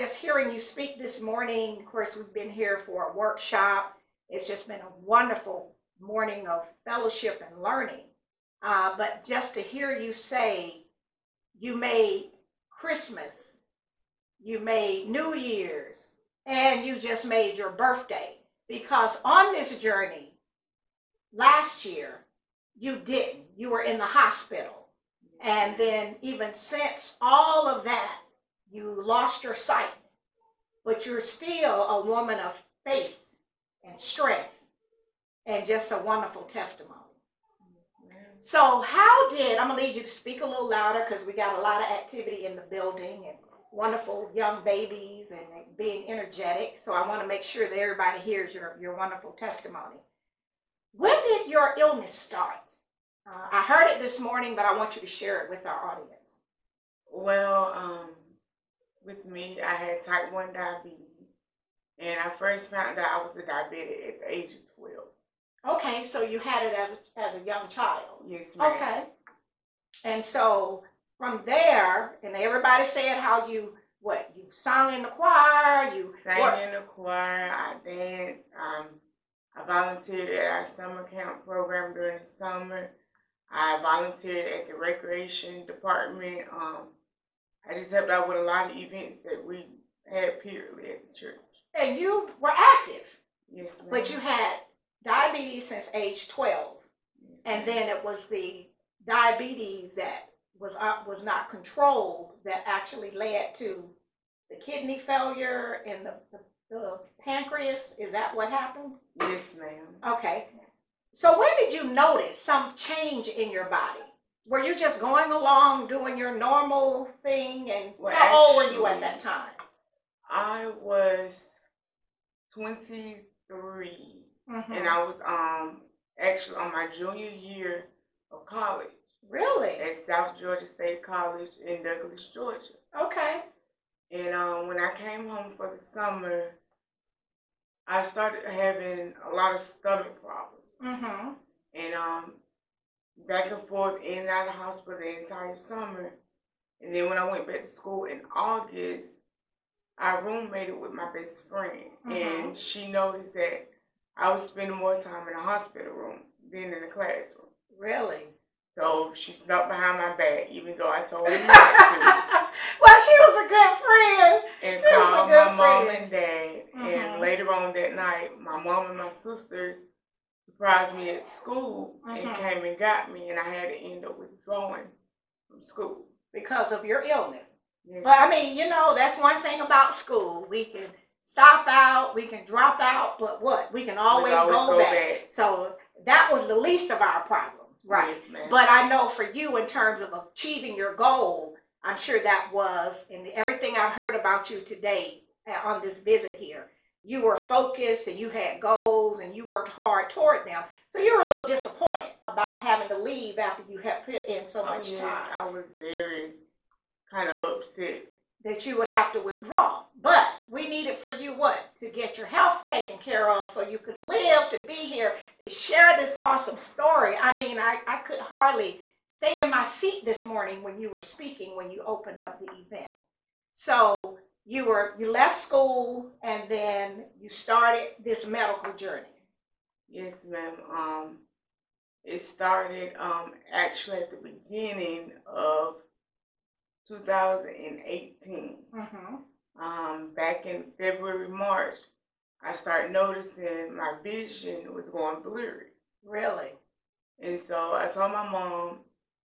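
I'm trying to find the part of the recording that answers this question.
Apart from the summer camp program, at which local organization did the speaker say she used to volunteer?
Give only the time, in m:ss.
1:24.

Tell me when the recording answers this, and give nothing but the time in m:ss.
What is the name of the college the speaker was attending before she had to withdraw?
2:10.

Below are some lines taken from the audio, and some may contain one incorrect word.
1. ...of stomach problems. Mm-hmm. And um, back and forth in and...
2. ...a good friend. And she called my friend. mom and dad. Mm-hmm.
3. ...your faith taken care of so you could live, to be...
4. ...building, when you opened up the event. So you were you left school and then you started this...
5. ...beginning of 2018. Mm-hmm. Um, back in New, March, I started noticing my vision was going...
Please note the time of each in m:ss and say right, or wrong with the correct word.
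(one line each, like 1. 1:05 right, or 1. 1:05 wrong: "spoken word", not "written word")
1. 2:19 right
2. 2:43 right
3. 3:32 wrong: "health", not "faith"
4. 3:41 wrong: "speaking", not "building"
5. 3:54 wrong: "February", not "New".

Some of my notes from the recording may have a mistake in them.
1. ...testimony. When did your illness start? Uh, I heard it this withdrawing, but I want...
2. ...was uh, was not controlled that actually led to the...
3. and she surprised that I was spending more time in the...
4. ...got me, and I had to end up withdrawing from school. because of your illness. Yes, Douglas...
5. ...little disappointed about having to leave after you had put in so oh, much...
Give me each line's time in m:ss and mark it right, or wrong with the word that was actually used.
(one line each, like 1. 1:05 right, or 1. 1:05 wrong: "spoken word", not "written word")
1. 0:49 wrong: "morning", not "withdrawing"
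2. 1:40 right
3. 2:32 wrong: "noticed", not "surprised"
4. 2:52 wrong: "But", not "Douglas"
5. 3:21 right.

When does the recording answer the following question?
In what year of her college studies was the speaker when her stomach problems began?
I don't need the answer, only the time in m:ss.
2:06.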